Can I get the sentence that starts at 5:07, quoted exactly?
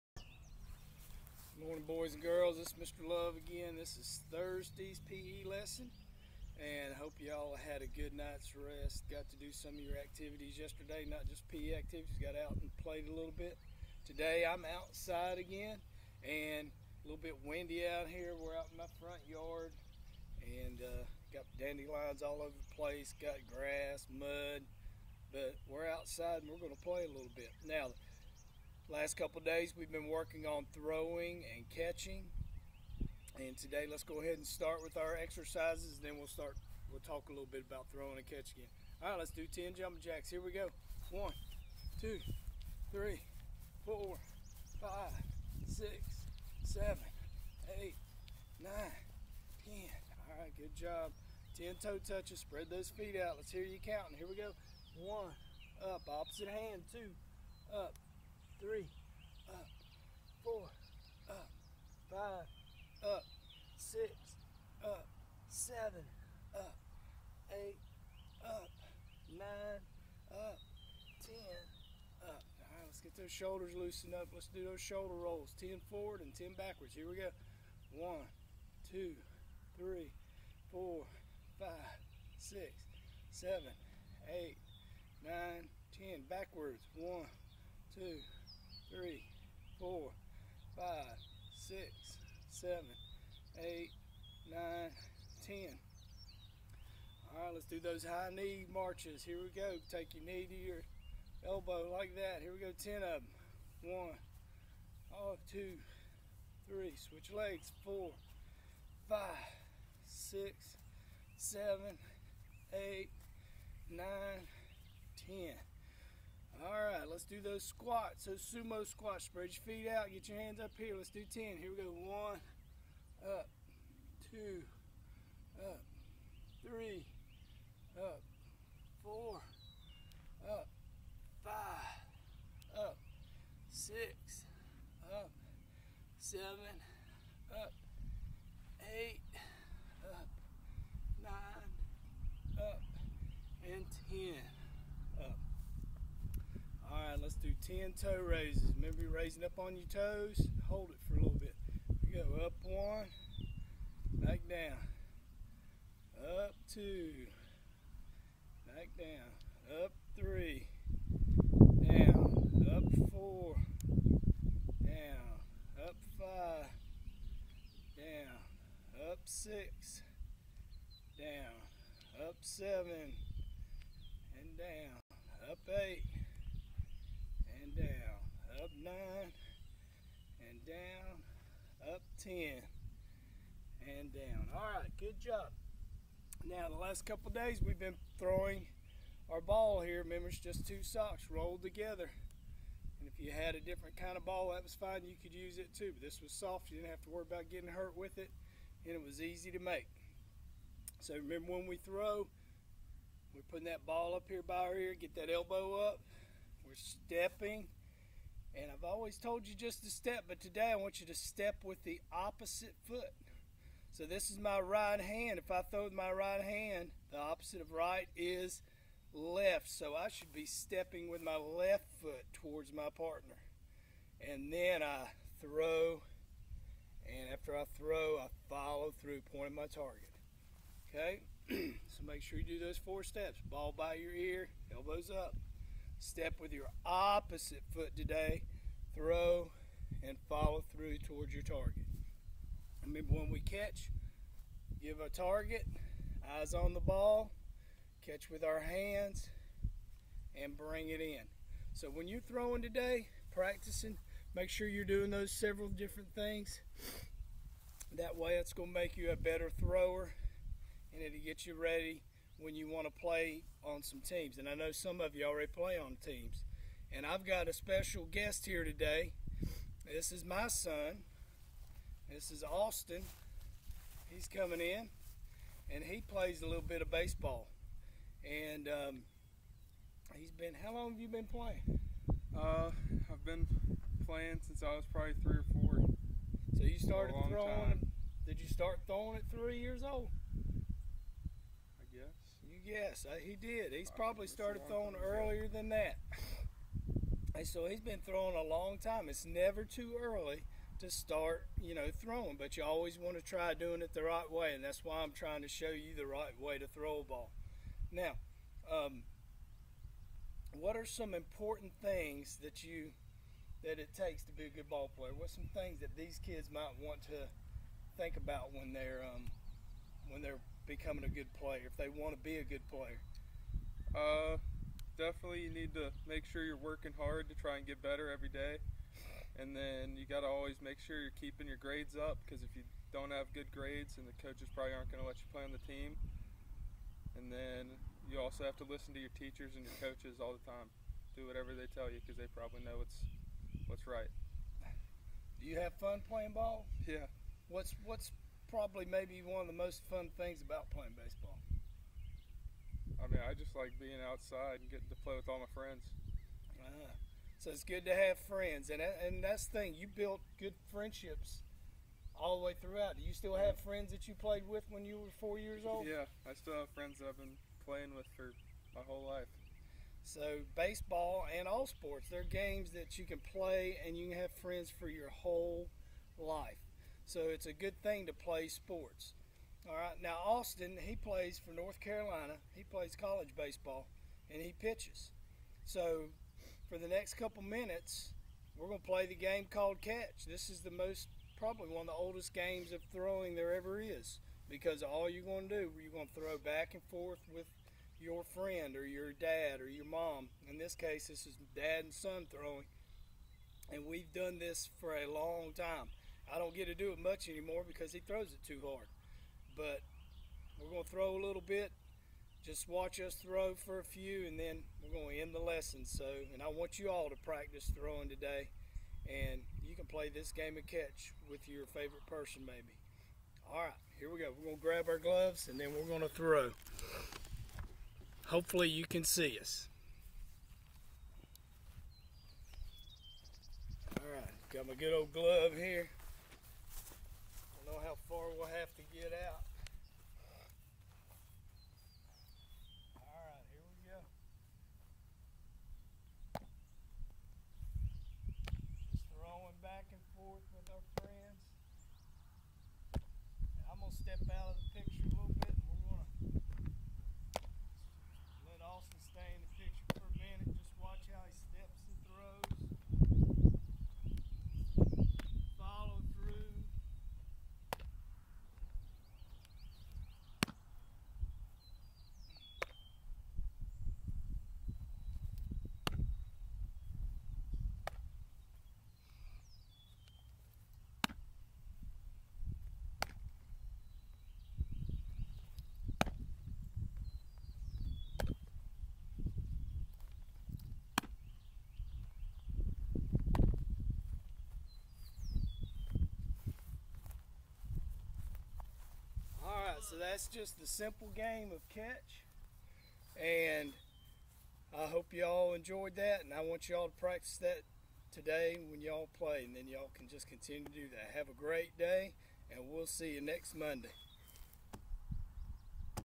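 Now, um, what are some important things that you that it takes to be a good ball player?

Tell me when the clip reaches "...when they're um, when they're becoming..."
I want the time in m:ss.
5:18.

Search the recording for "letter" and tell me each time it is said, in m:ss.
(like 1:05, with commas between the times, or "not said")
not said.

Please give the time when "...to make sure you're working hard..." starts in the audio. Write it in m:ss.
5:25.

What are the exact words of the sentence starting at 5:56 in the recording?
Ah, so it's good to have friends, and uh, and that's the thing.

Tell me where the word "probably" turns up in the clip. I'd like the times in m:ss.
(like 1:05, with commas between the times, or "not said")
4:44, 4:53, 5:34, 5:42, 5:48, 6:31.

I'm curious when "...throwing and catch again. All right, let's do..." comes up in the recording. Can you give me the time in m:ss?
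0:37.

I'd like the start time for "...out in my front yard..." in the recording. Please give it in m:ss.
0:18.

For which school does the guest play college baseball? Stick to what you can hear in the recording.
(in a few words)
North Carolina.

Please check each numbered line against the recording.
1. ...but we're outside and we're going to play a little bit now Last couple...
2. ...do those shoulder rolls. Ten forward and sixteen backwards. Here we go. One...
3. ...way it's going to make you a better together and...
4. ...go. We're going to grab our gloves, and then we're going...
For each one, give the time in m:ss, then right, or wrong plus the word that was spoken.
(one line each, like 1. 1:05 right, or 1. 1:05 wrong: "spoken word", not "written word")
1. 0:25 right
2. 1:14 wrong: "ten", not "sixteen"
3. 4:18 wrong: "thrower", not "together"
4. 7:04 right.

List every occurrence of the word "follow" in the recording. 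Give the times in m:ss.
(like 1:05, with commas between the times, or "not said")
3:48, 4:00.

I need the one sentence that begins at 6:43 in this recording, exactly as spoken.
And we've done this for a long time.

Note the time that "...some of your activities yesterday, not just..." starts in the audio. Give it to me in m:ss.
0:09.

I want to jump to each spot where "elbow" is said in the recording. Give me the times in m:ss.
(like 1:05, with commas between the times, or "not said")
1:41, 3:25, 3:54.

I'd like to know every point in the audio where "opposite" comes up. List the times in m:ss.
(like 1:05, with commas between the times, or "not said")
0:56, 3:32, 3:37, 3:56.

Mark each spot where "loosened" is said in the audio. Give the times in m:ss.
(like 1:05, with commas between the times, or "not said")
1:13.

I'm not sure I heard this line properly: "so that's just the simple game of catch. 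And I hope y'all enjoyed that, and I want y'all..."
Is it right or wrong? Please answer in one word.
right.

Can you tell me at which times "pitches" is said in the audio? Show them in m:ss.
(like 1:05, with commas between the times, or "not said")
6:24.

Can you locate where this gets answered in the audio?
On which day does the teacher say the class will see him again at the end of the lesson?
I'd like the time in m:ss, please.
8:33.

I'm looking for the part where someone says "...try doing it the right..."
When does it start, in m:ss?
5:03.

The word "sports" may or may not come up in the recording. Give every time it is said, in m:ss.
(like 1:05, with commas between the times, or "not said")
6:11, 6:18.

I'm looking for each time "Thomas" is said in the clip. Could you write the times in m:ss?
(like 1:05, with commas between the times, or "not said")
not said.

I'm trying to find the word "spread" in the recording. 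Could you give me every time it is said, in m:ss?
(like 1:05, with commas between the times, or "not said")
0:52, 1:59.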